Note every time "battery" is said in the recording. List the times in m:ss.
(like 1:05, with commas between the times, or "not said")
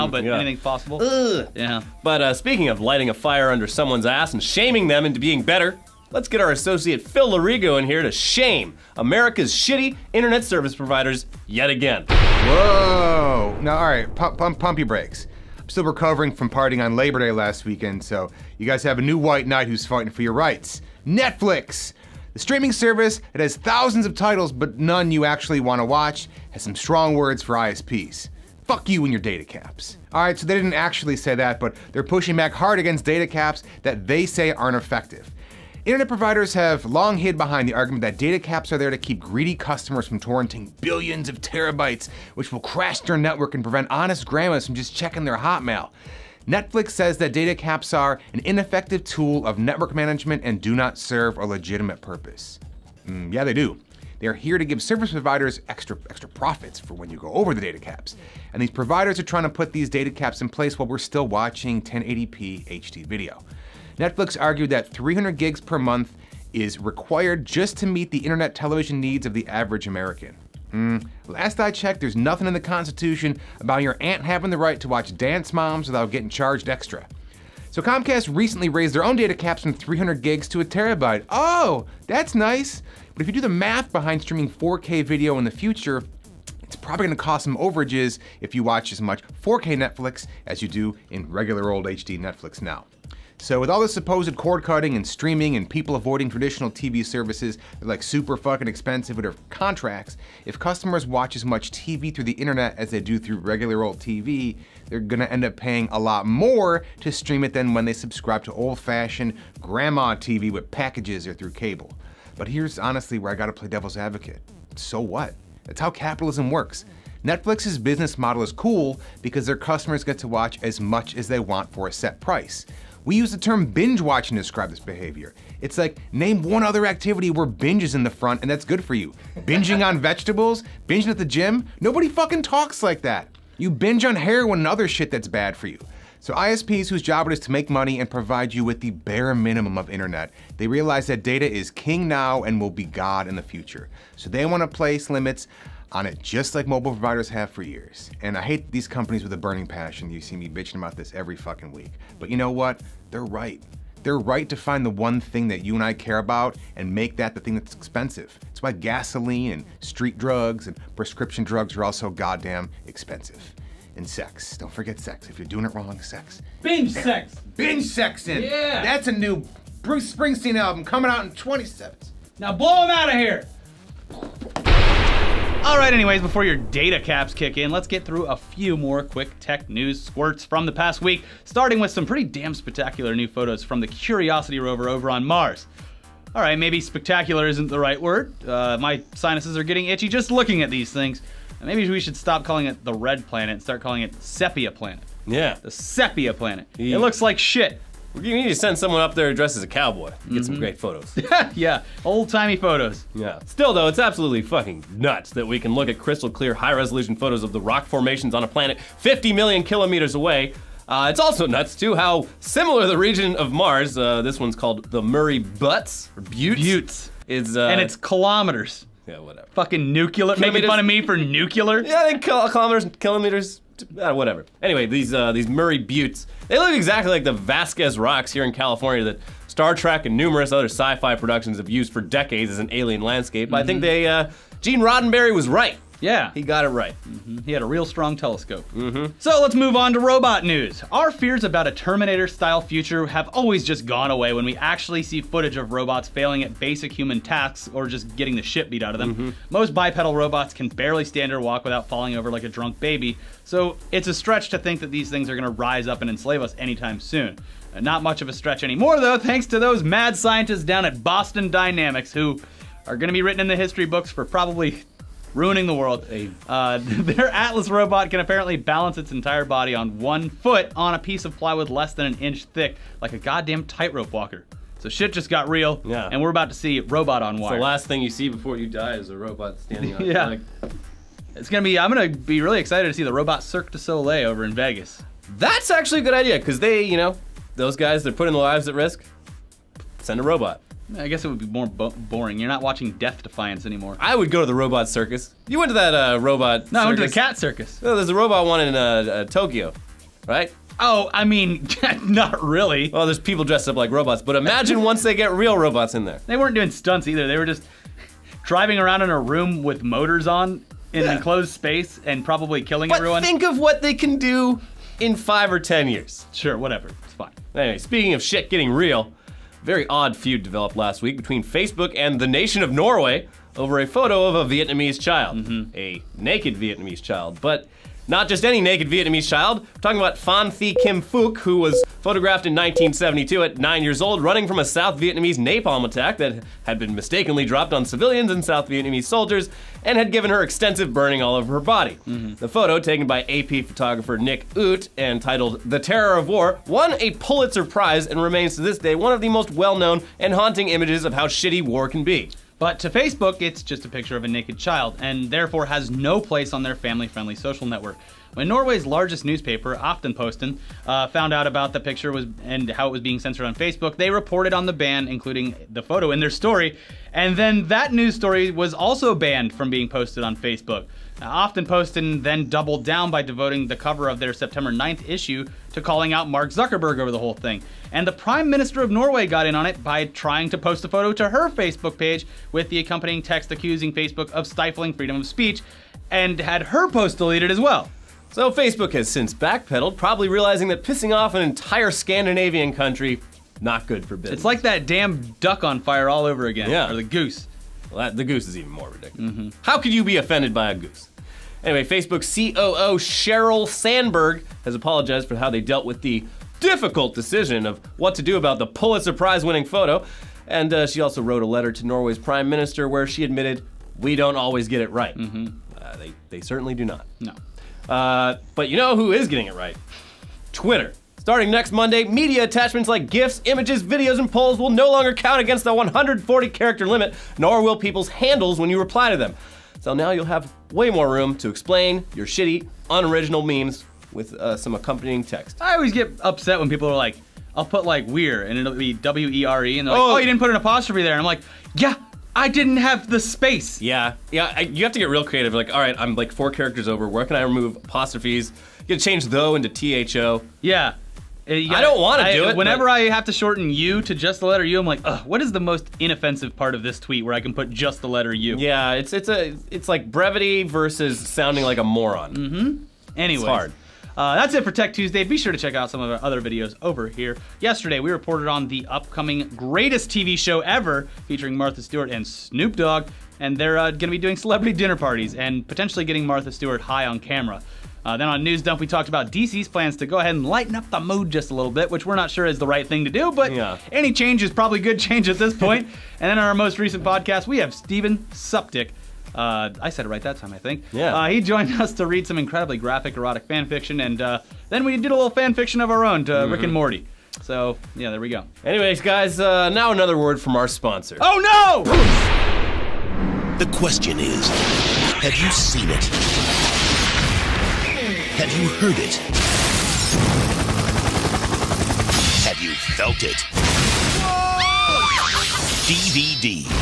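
not said.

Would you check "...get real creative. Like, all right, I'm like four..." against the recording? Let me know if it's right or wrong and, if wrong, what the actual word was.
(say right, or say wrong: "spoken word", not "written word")
right.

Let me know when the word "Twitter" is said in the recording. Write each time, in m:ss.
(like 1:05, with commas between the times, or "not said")
7:00.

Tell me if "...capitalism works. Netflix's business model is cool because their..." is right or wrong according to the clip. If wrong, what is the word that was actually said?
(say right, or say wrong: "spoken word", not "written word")
right.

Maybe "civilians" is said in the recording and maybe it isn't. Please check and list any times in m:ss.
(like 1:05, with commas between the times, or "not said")
5:37.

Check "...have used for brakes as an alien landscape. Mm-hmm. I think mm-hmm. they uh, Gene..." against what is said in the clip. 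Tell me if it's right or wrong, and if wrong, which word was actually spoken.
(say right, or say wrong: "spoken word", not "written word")
wrong: "decades", not "brakes".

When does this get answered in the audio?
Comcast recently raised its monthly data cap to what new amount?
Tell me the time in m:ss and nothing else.
1:20.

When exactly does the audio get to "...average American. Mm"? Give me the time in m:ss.
1:09.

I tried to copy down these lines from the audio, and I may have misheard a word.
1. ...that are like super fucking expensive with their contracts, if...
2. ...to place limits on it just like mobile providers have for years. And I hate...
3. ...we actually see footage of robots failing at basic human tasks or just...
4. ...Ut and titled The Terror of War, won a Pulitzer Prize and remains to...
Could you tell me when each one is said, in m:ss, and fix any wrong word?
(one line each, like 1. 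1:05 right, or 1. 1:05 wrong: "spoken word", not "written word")
1. 1:37 right
2. 2:24 right
3. 4:04 right
4. 5:44 right.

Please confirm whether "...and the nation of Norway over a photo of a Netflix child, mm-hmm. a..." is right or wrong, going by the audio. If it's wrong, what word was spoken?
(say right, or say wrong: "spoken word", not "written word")
wrong: "Vietnamese", not "Netflix".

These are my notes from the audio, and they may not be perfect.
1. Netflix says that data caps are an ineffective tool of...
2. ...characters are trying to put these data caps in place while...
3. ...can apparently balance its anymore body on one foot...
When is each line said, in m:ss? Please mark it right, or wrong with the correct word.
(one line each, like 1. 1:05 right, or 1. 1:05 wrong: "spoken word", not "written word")
1. 0:46 right
2. 0:58 wrong: "providers", not "characters"
3. 4:28 wrong: "entire", not "anymore".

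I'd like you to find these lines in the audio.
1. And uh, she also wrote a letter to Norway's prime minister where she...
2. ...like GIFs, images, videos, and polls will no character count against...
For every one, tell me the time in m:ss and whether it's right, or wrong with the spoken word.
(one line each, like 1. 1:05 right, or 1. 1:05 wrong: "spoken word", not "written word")
1. 6:50 right
2. 7:02 wrong: "longer", not "character".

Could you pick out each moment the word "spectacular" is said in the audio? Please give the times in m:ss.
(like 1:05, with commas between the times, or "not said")
3:02, 3:06.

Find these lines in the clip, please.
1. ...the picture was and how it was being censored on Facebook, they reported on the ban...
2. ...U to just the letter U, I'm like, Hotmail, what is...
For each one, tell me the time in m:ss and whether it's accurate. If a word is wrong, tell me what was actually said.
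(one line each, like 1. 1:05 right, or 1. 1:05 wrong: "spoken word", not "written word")
1. 6:01 right
2. 7:33 wrong: "Ugh", not "Hotmail".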